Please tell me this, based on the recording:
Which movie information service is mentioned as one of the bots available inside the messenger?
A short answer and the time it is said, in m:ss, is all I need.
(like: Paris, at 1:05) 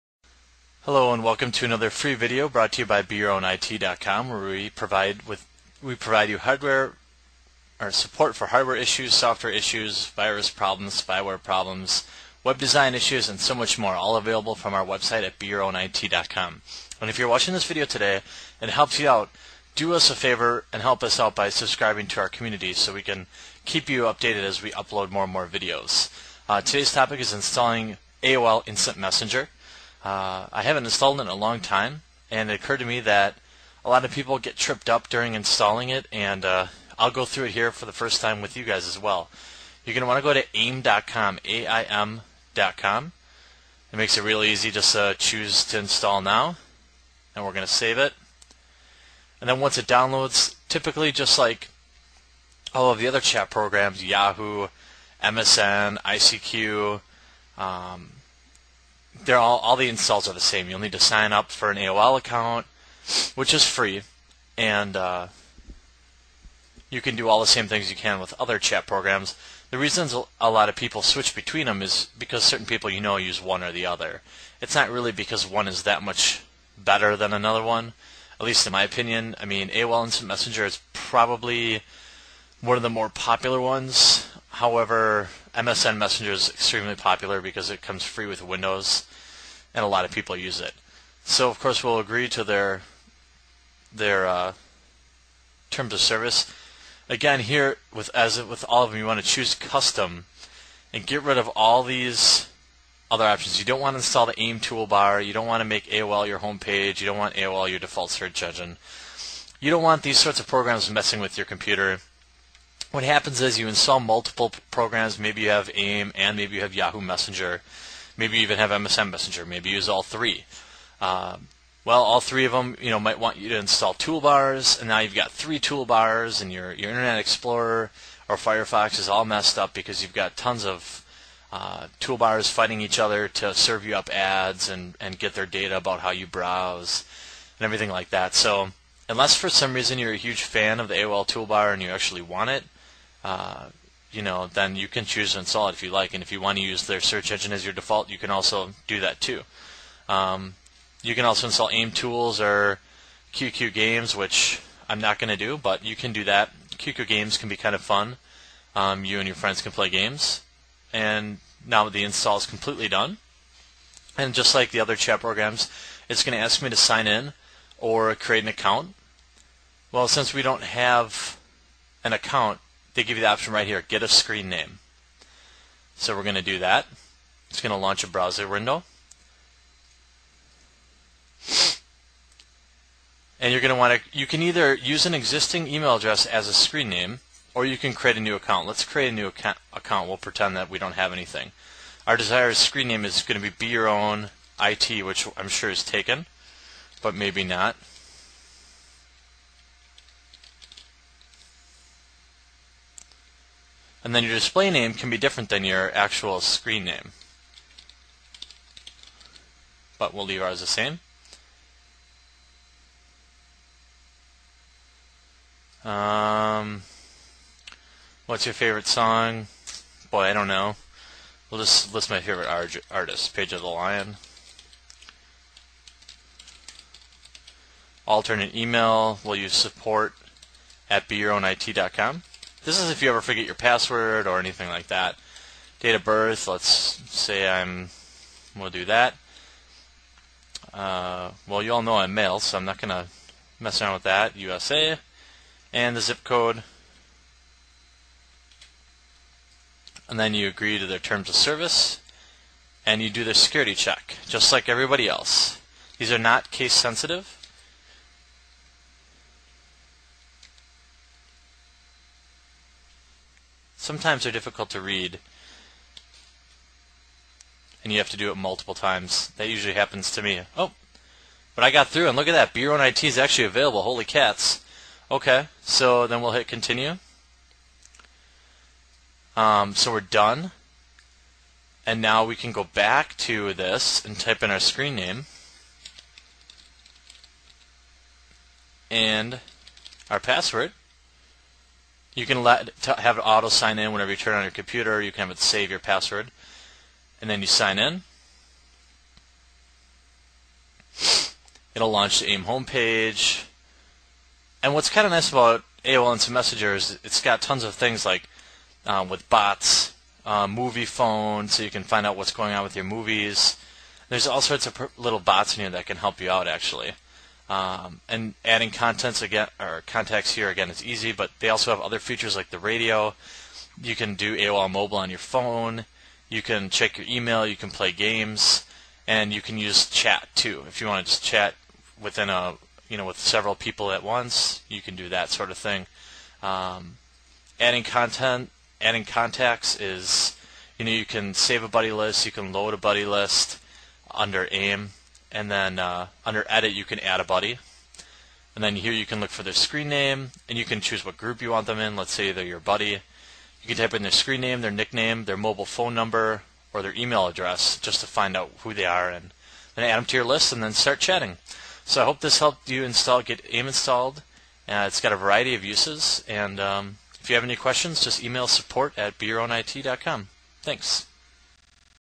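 Moviefone, at 5:10.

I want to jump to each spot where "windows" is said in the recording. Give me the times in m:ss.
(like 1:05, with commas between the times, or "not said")
1:28, 2:58.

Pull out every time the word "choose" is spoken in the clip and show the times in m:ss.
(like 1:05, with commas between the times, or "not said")
0:45, 1:39, 2:25, 5:50.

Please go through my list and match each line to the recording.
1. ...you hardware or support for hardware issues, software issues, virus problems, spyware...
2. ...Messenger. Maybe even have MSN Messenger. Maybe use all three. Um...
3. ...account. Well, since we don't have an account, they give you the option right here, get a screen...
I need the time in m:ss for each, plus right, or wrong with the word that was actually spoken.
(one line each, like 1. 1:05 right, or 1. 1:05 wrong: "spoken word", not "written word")
1. 0:06 right
2. 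1:57 right
3. 2:48 right.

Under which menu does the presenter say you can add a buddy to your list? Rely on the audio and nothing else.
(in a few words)
edit.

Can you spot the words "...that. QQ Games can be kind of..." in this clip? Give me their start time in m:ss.
2:36.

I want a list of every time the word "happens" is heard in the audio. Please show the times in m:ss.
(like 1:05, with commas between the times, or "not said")
1:53, 4:29.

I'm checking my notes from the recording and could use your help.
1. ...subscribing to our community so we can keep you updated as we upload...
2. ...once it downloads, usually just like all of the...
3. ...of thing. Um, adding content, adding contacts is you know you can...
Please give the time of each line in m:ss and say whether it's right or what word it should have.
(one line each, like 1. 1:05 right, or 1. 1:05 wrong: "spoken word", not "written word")
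1. 0:21 right
2. 0:49 wrong: "typically", not "usually"
3. 5:35 right.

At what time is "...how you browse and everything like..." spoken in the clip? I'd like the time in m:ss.
2:15.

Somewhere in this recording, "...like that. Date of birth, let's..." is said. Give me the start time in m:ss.
3:54.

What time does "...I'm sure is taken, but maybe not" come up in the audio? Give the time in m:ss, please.
3:15.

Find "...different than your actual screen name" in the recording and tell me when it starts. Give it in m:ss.
3:25.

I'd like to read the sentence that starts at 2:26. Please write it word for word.
And if you want to use their search engine as your default, you can also do that too.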